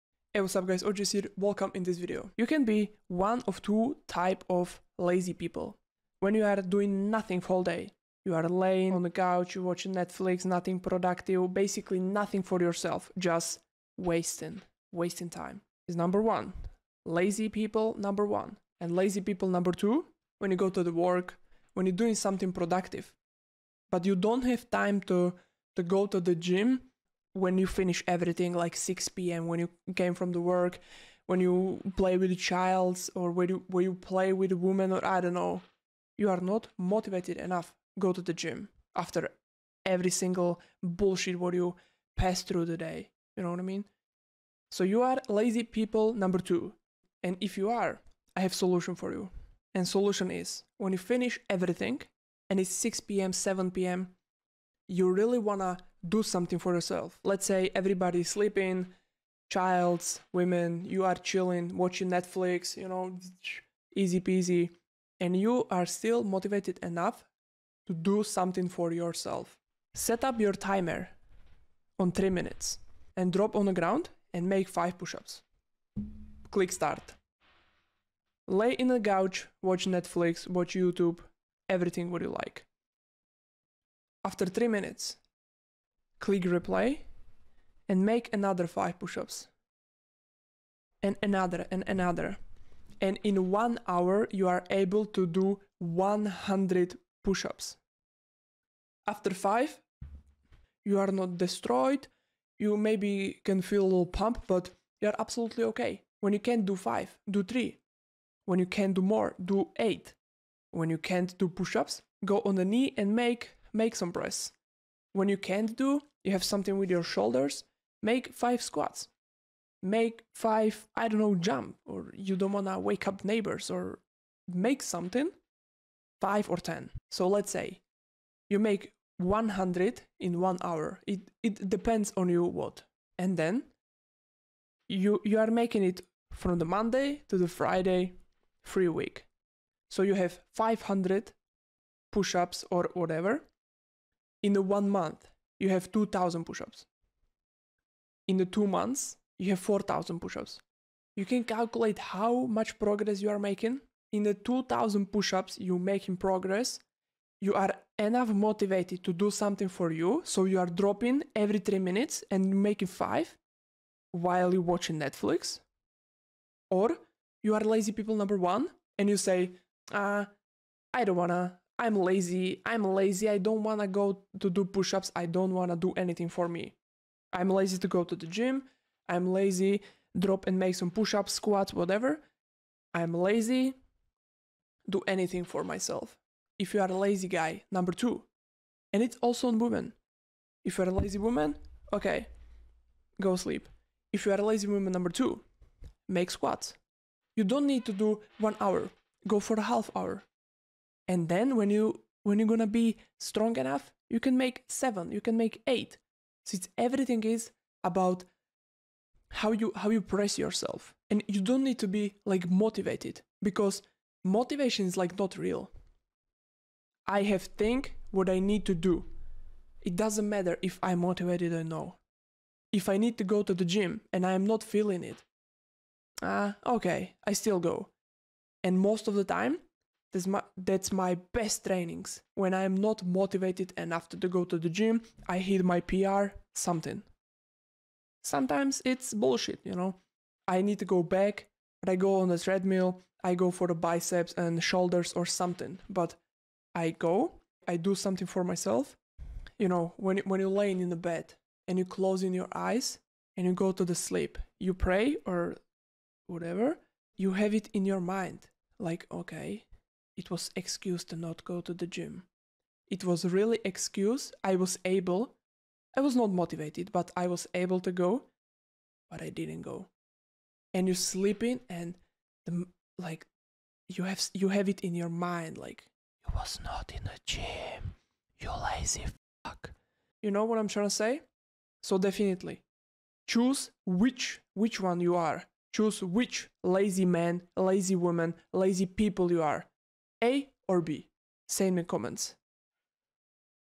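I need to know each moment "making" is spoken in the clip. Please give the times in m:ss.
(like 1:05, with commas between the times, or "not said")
2:15, 2:33, 2:42.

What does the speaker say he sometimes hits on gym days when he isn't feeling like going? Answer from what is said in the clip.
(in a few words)
PR.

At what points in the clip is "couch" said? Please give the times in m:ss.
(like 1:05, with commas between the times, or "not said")
0:09, 1:18.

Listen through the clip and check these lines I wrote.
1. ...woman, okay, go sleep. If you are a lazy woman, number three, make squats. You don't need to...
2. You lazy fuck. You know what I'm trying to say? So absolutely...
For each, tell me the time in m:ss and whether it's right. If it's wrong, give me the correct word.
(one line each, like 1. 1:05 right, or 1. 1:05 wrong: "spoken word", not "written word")
1. 3:11 wrong: "two", not "three"
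2. 4:38 wrong: "definitely", not "absolutely".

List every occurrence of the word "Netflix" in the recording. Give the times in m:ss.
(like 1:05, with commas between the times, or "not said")
0:09, 1:02, 1:19, 2:44.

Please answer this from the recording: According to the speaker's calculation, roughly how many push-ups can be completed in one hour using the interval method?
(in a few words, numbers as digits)
100.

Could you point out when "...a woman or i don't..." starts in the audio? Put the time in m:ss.
0:34.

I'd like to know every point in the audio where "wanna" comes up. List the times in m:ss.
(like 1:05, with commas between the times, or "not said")
0:55, 2:02, 2:51.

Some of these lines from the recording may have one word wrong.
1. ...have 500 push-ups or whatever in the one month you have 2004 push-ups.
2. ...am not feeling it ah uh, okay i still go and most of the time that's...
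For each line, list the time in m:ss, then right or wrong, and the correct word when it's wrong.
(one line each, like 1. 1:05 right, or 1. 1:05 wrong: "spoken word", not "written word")
1. 2:20 wrong: "2000", not "2004"
2. 3:44 right.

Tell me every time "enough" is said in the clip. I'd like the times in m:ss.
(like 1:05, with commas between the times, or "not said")
0:37, 1:06, 2:37, 3:23, 3:53.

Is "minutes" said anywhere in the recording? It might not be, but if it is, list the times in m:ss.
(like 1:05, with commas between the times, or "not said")
1:12, 1:24, 2:41.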